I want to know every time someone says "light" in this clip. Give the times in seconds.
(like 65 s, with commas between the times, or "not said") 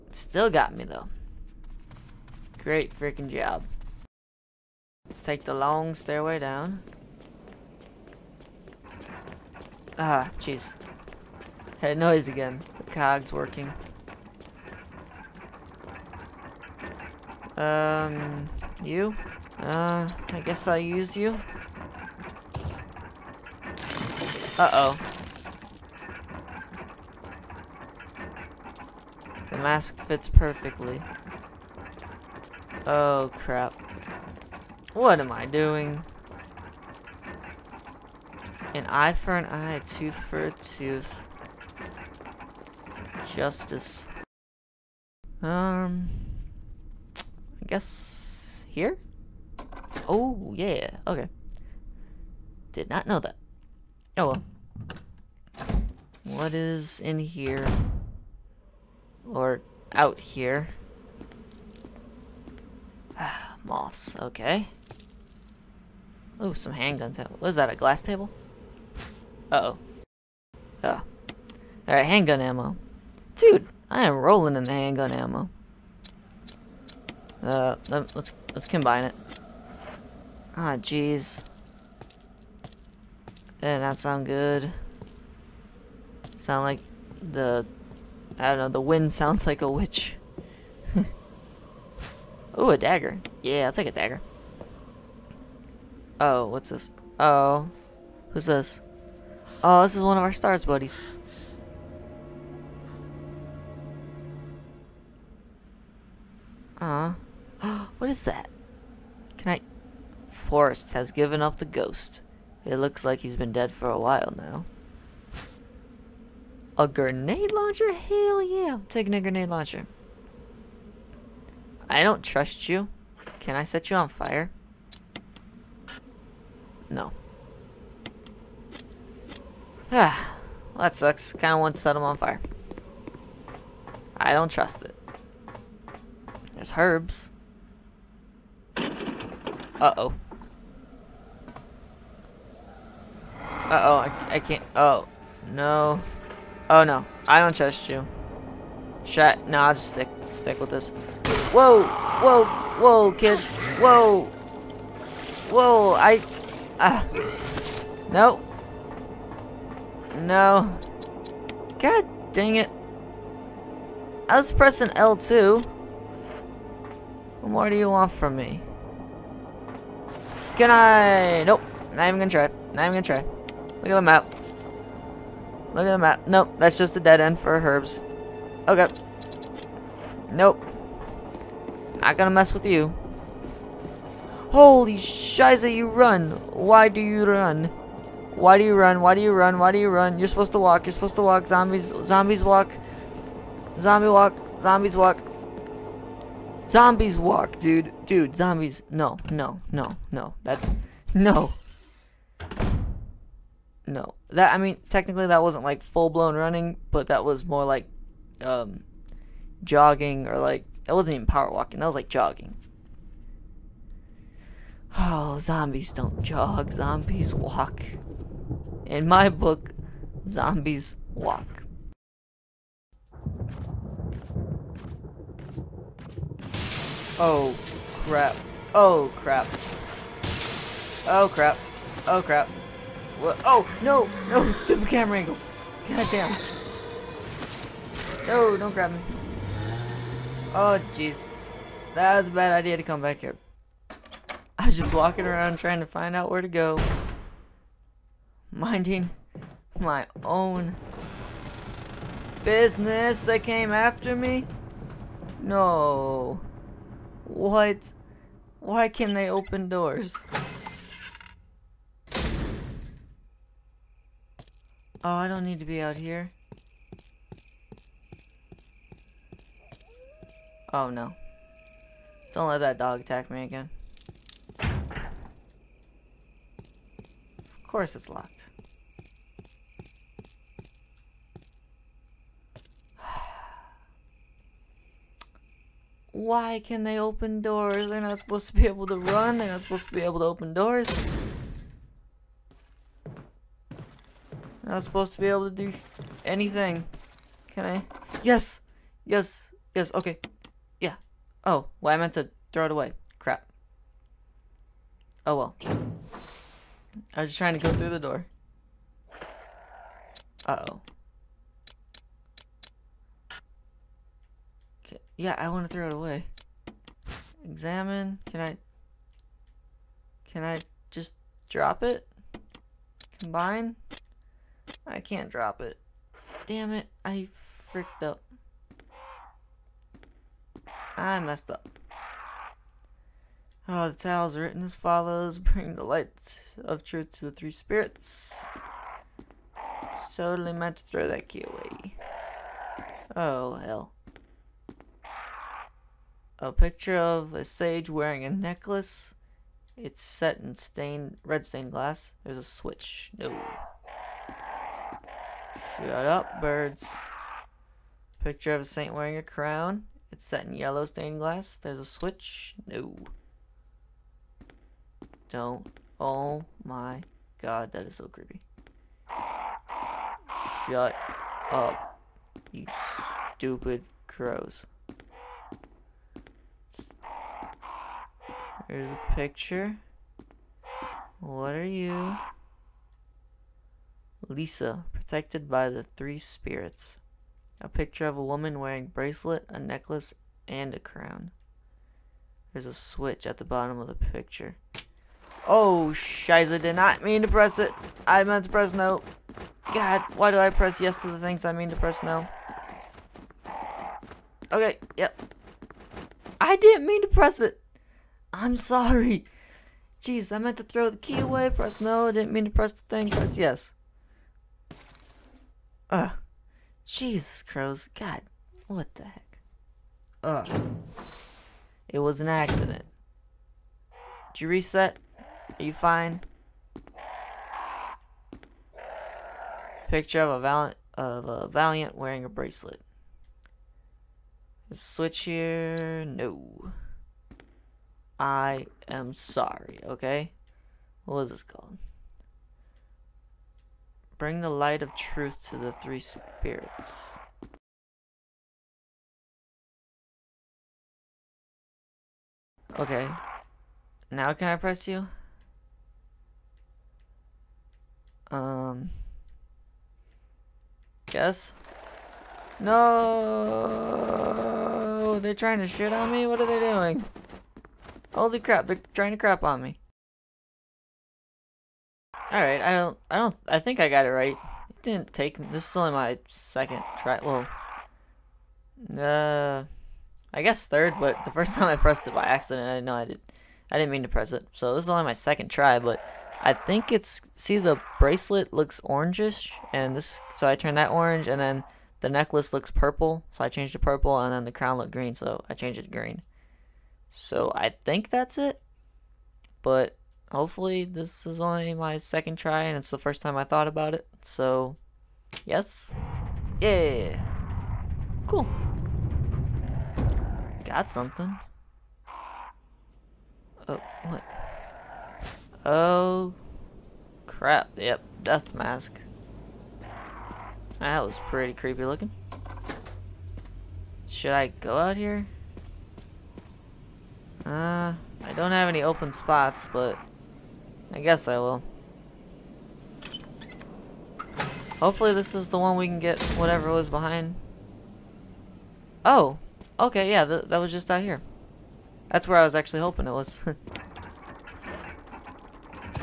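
335 s, 444 s.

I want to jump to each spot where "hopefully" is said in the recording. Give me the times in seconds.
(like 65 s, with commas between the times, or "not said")
500 s, 534 s.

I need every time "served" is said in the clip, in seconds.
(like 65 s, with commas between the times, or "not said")
not said.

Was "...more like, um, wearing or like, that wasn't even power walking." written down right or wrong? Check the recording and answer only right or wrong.
wrong.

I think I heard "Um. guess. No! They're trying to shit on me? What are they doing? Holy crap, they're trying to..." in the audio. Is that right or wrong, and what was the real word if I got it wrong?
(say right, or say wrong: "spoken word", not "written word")
right.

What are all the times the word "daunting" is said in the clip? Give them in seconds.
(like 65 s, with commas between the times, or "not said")
not said.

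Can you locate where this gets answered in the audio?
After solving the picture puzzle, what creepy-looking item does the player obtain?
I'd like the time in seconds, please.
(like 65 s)
518 s.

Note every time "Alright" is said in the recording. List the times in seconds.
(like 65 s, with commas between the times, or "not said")
71 s, 472 s.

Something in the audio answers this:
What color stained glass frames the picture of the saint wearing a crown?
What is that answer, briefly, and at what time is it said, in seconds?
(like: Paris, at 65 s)
Yellow, at 360 s.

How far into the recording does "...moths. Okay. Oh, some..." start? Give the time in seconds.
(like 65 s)
63 s.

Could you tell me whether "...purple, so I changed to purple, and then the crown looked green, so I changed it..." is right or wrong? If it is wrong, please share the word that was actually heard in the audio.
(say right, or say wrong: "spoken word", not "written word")
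right.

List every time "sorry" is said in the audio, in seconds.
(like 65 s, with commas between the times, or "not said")
408 s, 439 s.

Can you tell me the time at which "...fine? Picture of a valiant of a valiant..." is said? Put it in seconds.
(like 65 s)
425 s.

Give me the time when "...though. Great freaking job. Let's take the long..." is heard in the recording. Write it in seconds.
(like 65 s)
0 s.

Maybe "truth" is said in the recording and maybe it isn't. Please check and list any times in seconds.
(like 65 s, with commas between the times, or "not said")
336 s, 444 s.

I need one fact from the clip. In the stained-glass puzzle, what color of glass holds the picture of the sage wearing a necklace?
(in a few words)
Red.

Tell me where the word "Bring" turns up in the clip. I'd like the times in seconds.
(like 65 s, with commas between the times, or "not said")
335 s, 444 s.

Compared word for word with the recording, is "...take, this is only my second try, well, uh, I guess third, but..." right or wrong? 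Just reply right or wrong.
right.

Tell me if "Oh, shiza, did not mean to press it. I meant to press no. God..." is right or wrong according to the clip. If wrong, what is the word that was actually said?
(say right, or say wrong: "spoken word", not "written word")
right.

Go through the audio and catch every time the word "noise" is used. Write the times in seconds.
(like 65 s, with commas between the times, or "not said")
11 s.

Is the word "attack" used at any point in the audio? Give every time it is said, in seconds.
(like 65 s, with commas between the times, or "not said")
273 s.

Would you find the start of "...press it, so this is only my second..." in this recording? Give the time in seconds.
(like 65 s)
484 s.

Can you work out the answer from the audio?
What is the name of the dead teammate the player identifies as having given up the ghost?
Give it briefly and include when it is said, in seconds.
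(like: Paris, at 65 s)
Forest, at 110 s.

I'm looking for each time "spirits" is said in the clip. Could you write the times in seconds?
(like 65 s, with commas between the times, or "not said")
337 s, 386 s, 445 s.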